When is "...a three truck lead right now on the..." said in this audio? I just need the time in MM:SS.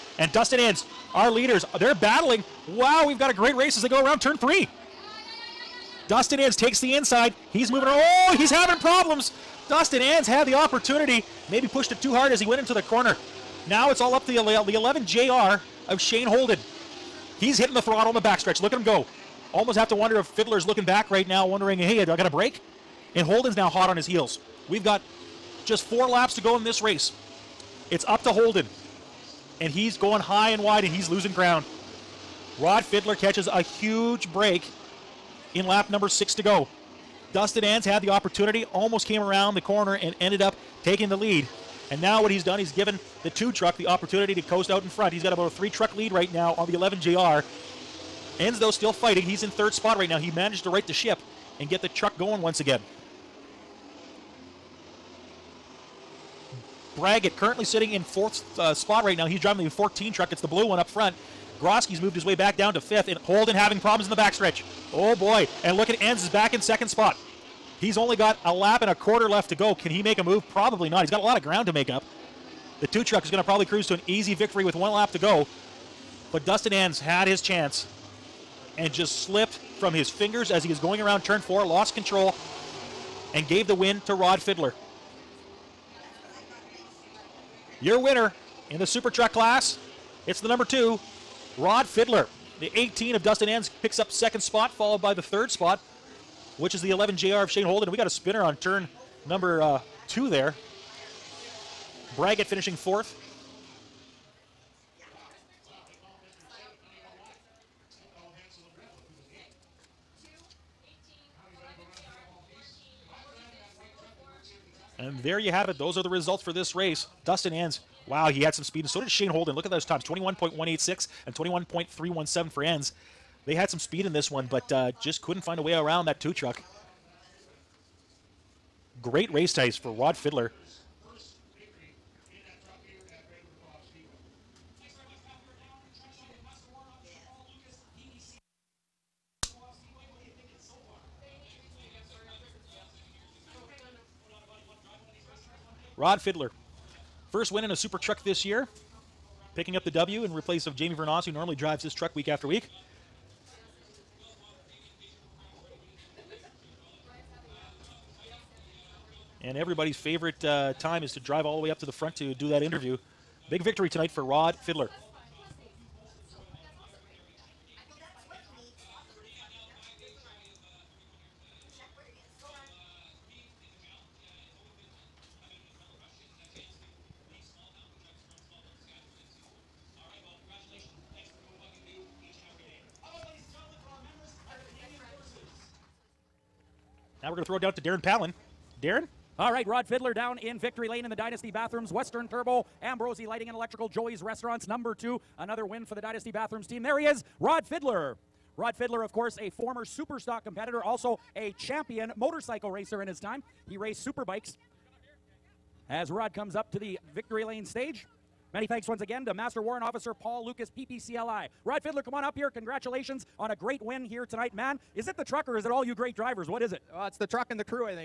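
00:45.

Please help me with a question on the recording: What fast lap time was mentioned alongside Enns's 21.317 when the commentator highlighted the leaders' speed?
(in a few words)
21.186.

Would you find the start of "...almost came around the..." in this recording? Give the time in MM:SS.
00:38.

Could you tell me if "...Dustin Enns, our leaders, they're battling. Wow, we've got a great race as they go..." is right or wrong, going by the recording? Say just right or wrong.
right.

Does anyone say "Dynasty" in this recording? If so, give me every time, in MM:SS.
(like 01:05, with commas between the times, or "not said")
03:11, 03:16.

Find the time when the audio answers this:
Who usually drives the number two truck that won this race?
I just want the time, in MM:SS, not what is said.
02:30.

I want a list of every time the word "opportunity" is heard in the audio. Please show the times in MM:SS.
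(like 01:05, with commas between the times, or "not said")
00:10, 00:38, 00:43.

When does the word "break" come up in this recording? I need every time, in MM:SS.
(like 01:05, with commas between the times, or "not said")
00:22, 00:34.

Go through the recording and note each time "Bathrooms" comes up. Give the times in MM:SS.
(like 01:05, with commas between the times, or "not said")
03:11, 03:16.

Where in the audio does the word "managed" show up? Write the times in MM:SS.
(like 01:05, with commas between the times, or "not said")
00:50.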